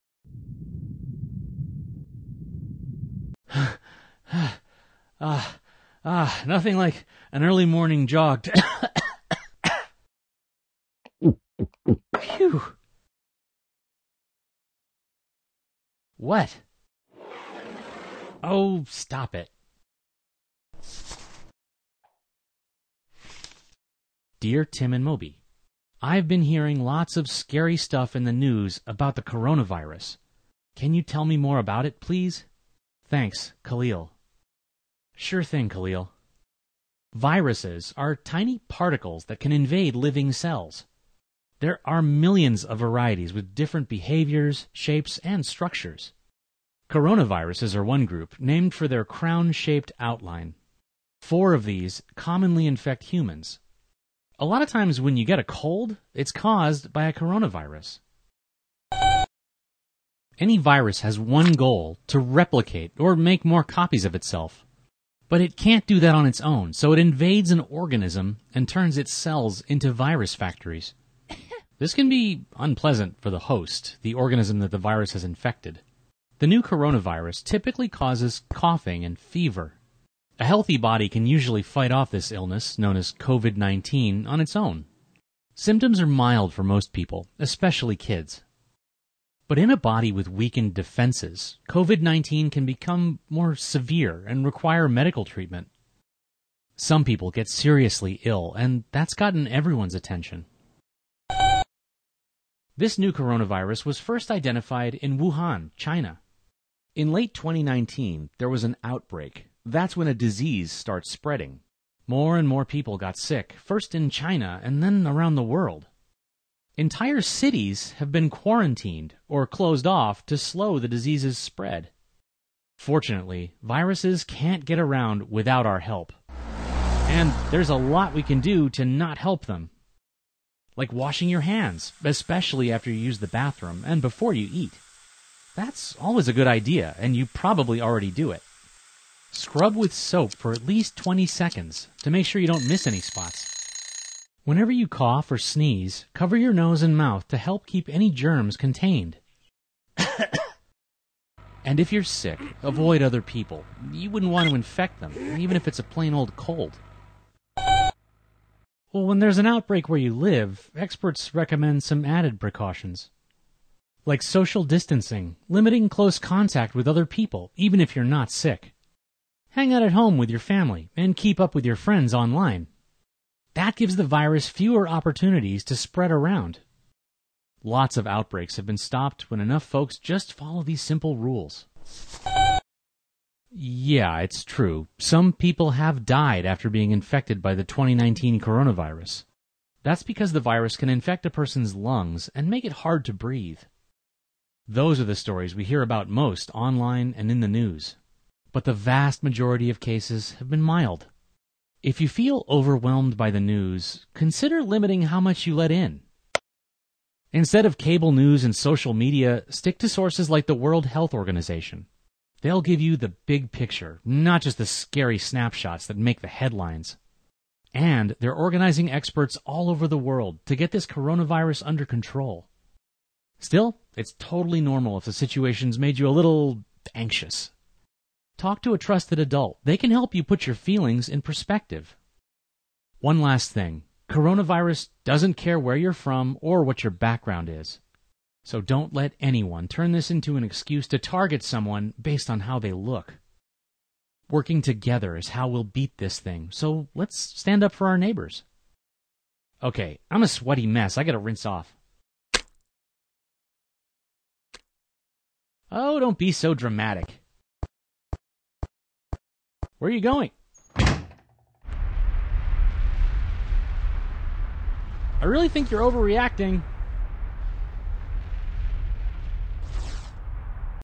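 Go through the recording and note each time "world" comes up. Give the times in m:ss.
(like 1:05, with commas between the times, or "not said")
1:55, 3:30, 3:39.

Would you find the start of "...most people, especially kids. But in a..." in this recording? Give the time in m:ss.
1:26.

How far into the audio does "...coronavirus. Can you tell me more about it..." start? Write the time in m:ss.
0:29.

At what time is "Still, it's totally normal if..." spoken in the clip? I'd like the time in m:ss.
3:43.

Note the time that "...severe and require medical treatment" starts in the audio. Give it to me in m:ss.
1:33.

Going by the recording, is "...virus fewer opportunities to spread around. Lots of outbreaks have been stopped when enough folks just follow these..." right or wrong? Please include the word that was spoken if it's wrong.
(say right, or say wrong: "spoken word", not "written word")
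right.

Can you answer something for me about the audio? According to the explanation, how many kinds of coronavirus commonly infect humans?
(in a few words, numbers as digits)
4.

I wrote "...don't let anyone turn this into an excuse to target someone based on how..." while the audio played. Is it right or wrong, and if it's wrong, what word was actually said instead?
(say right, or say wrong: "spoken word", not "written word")
right.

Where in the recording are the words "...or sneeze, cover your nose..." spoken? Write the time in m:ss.
2:25.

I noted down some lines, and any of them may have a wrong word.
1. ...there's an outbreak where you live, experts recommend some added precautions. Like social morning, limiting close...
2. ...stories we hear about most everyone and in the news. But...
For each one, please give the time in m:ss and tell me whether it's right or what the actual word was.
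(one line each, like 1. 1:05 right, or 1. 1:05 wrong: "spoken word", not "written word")
1. 2:39 wrong: "distancing", not "morning"
2. 3:15 wrong: "online", not "everyone".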